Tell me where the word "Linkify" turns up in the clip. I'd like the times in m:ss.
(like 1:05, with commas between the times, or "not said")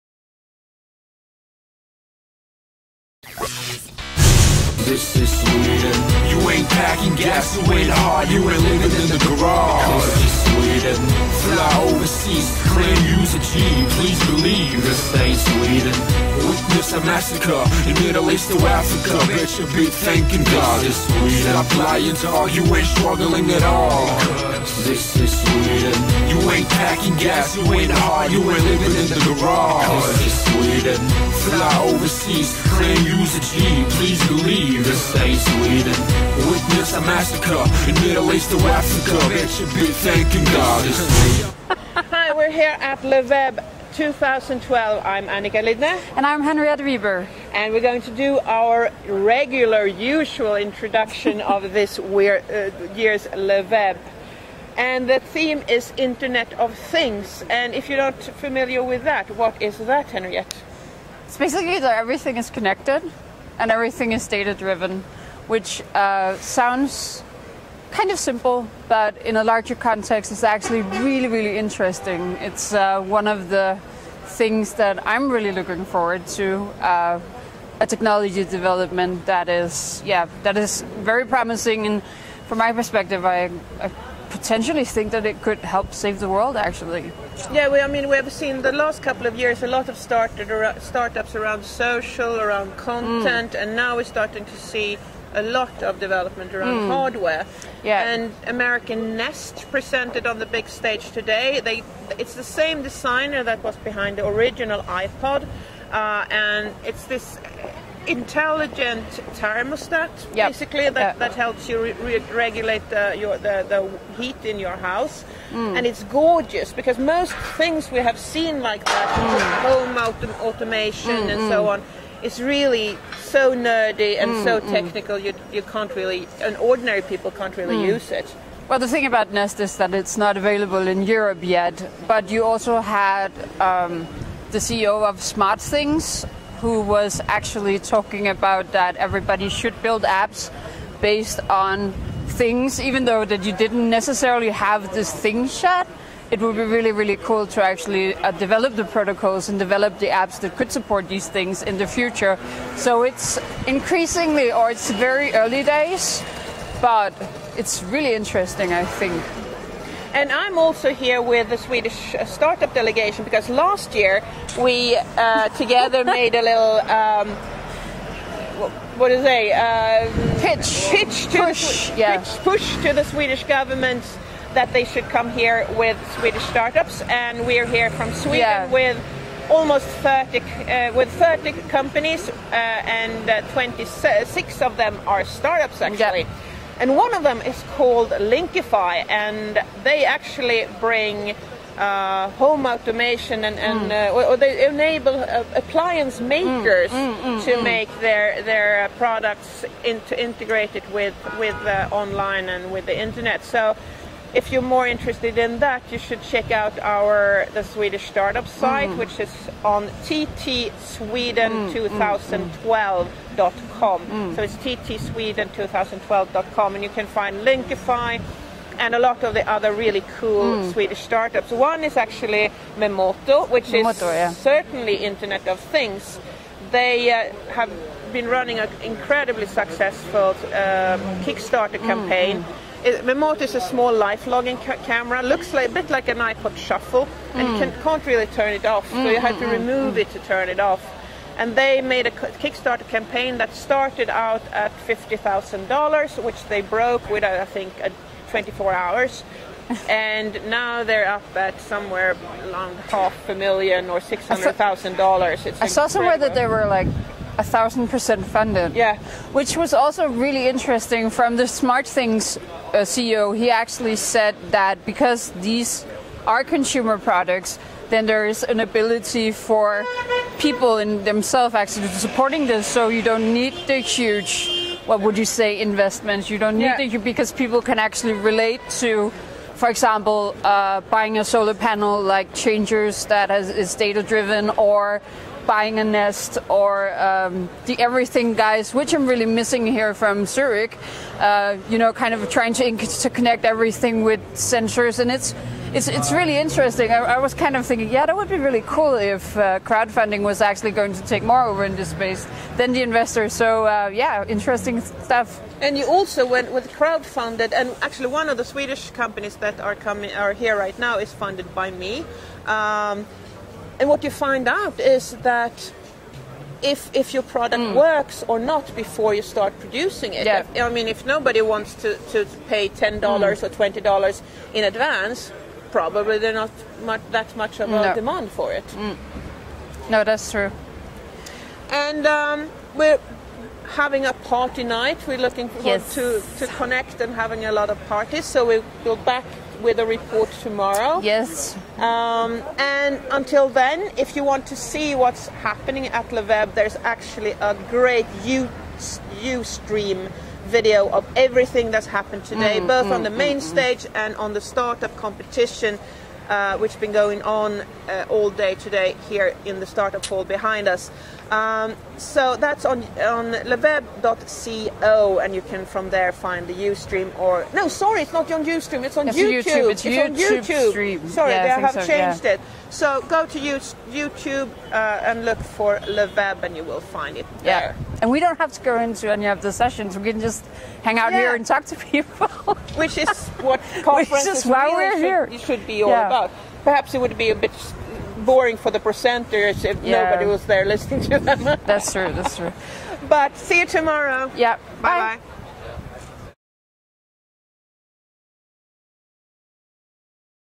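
3:08, 3:37.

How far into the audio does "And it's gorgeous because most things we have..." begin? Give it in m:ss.
1:55.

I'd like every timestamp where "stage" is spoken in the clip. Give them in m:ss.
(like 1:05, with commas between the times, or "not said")
1:40, 5:53.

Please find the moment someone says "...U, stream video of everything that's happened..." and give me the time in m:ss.
5:48.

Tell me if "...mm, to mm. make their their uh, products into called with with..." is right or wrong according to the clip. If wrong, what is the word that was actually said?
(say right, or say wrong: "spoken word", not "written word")
wrong: "integrated", not "called".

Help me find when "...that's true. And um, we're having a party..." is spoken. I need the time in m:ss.
5:30.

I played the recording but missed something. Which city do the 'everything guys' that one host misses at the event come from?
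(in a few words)
Zurich.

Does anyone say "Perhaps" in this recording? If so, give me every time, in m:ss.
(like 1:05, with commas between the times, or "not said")
6:26.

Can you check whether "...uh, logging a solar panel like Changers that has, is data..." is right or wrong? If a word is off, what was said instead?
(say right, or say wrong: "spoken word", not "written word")
wrong: "buying", not "logging".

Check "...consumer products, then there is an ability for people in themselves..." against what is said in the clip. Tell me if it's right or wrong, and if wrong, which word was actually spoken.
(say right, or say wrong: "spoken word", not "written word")
right.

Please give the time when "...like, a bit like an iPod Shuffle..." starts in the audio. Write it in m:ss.
3:55.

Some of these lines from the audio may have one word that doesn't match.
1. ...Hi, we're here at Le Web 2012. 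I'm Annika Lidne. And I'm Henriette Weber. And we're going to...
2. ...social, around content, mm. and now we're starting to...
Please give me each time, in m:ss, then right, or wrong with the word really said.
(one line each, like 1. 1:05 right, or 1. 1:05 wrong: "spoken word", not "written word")
1. 0:42 right
2. 1:31 right.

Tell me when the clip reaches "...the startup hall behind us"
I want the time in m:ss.
5:59.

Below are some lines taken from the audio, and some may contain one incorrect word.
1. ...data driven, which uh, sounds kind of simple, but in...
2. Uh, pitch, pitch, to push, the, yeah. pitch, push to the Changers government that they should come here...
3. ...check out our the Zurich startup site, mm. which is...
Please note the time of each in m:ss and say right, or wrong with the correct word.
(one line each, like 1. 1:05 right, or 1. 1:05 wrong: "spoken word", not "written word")
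1. 1:04 right
2. 2:49 wrong: "Swedish", not "Changers"
3. 3:26 wrong: "Swedish", not "Zurich".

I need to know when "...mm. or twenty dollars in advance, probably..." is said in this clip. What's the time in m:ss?
5:23.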